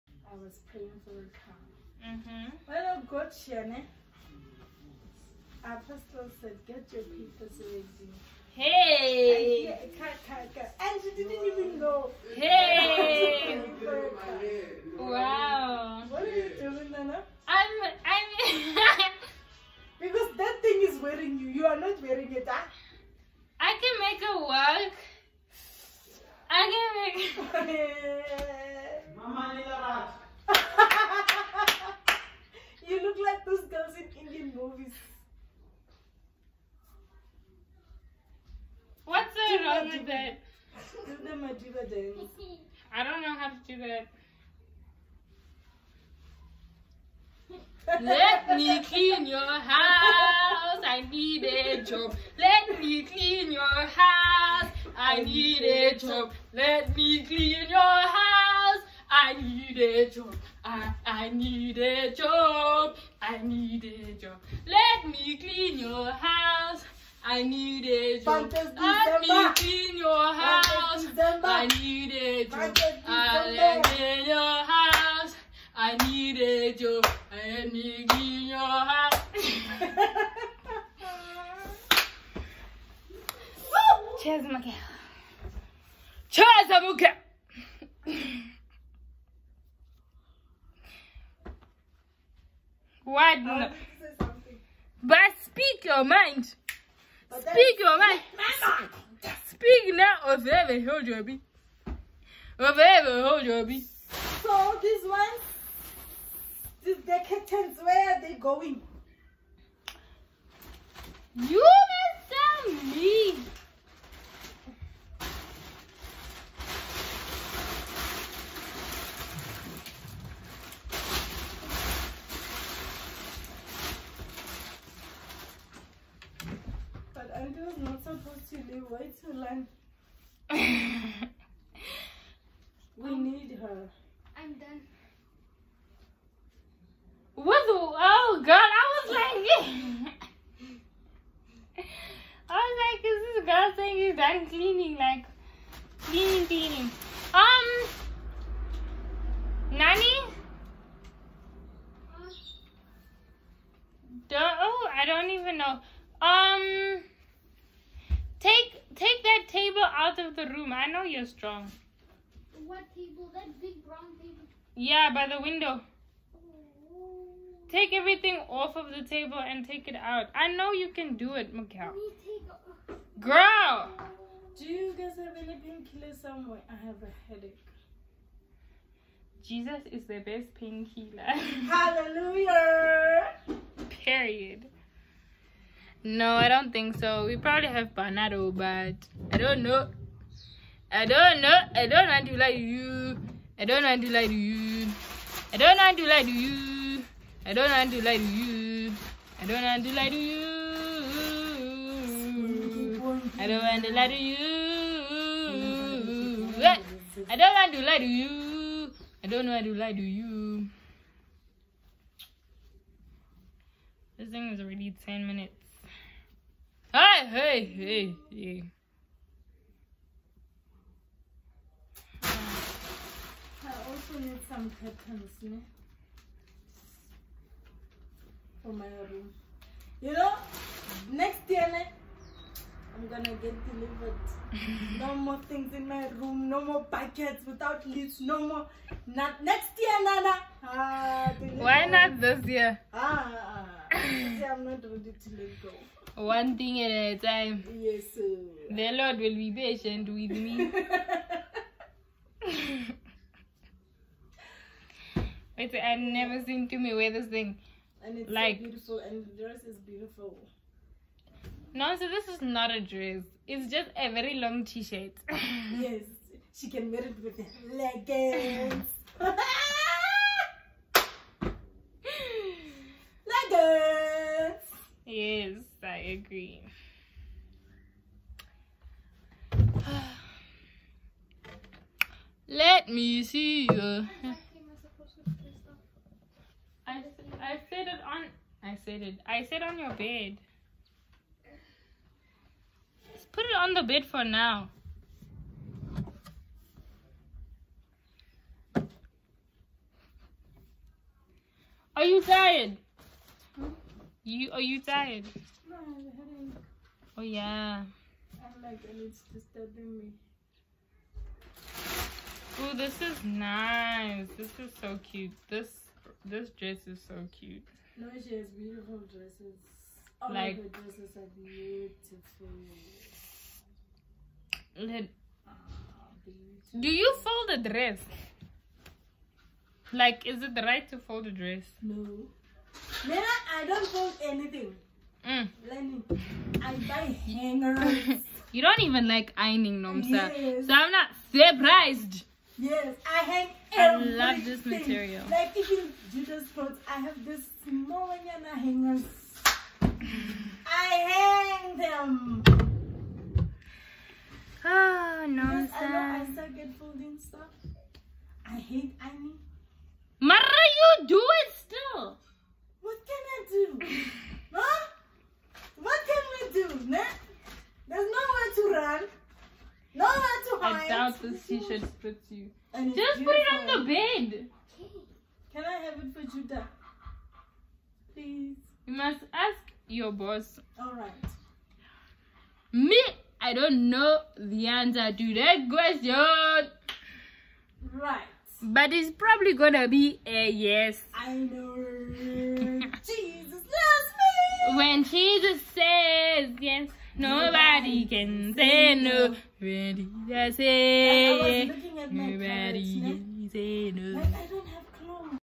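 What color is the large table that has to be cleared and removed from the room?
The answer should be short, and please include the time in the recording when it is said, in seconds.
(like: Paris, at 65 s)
Brown, at 163 s.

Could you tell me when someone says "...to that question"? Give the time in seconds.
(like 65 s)
385 s.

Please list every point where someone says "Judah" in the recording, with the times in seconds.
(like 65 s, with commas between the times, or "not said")
346 s, 376 s.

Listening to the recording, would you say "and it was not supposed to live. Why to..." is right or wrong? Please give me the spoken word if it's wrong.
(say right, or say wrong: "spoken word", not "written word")
right.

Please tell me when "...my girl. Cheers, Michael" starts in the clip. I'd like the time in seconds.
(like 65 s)
84 s.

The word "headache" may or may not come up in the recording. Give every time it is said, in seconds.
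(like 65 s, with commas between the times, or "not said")
177 s, 305 s.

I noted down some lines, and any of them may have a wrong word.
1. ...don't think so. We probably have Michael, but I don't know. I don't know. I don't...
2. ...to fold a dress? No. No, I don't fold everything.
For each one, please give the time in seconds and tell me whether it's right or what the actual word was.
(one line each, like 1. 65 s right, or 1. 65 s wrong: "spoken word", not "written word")
1. 186 s wrong: "Panado", not "Michael"
2. 330 s wrong: "anything", not "everything".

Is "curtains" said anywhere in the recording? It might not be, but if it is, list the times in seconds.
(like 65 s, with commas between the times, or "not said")
107 s, 224 s.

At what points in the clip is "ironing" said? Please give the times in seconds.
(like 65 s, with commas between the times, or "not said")
339 s, 359 s.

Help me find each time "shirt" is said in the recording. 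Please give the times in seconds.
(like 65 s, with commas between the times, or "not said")
264 s, 371 s.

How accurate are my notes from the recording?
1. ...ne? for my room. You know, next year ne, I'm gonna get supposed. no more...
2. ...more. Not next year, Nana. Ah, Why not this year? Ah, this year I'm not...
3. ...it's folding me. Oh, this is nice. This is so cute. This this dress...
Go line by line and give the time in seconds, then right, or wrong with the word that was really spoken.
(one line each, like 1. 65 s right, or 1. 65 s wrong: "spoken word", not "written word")
1. 225 s wrong: "delivered", not "supposed"
2. 238 s right
3. 309 s wrong: "disturbing", not "folding".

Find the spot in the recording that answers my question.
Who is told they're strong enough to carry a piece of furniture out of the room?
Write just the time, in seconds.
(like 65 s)
171 s.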